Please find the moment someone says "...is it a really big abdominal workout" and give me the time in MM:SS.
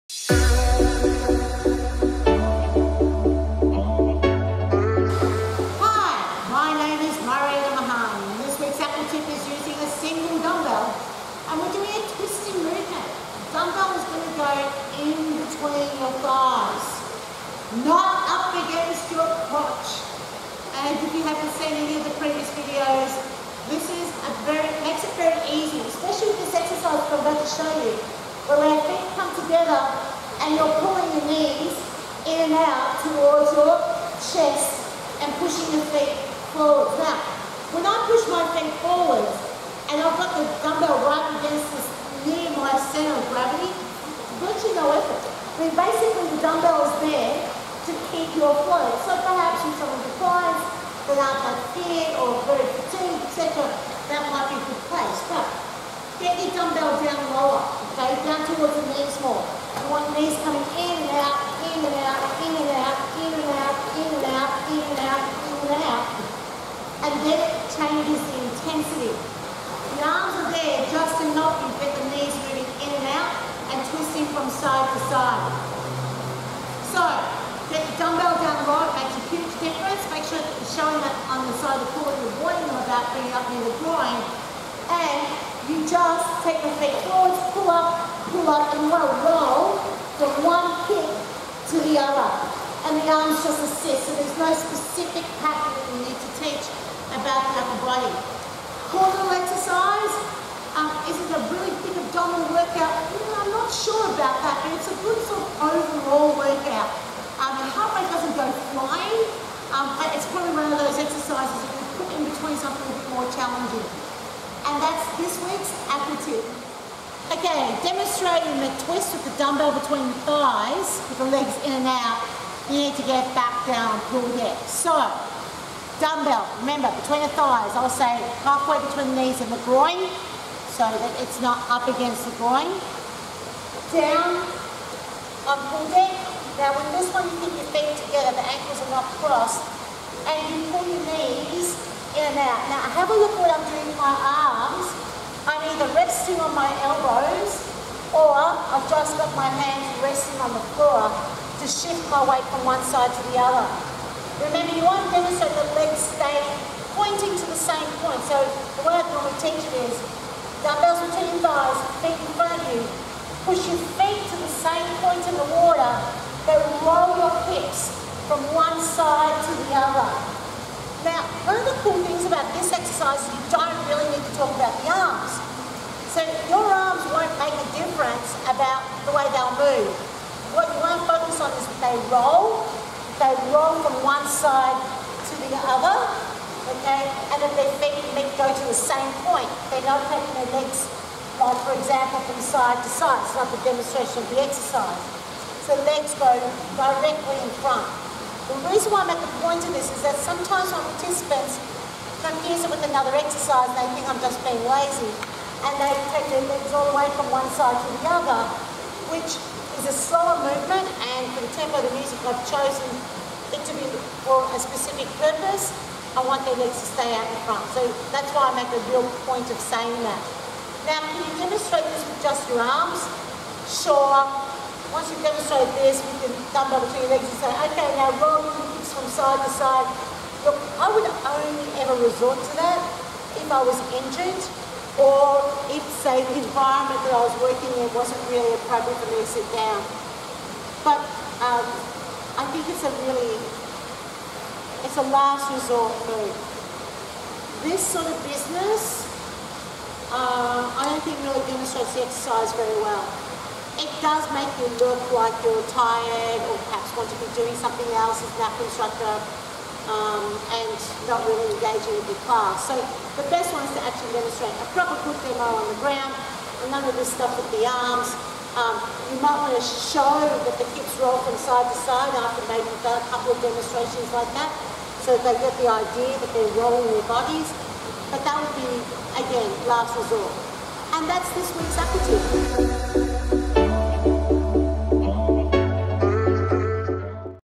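01:41.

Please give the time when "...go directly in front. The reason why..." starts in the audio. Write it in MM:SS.
03:16.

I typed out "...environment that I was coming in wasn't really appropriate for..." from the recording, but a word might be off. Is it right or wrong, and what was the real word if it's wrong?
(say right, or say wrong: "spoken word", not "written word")
wrong: "working", not "coming".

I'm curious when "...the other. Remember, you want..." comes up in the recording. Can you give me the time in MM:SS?
02:33.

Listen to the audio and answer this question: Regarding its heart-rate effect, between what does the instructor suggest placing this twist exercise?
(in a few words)
something a bit more challenging.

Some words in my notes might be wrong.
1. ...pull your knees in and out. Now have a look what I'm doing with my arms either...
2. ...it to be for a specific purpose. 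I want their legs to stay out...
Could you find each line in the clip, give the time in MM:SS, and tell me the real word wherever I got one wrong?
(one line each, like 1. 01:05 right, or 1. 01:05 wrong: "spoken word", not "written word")
1. 02:20 right
2. 03:33 right.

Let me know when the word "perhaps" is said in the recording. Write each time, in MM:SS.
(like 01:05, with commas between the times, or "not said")
00:49, 04:16.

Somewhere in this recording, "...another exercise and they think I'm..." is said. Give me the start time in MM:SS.
03:22.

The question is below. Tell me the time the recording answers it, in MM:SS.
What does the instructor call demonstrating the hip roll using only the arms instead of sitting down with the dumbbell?
04:05.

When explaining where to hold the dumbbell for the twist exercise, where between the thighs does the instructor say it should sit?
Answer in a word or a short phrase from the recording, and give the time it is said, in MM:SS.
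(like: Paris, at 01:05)
halfway between the knees and the groin, at 02:08.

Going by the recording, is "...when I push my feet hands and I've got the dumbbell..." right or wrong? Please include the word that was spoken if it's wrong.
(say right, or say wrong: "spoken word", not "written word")
wrong: "forwards", not "hands".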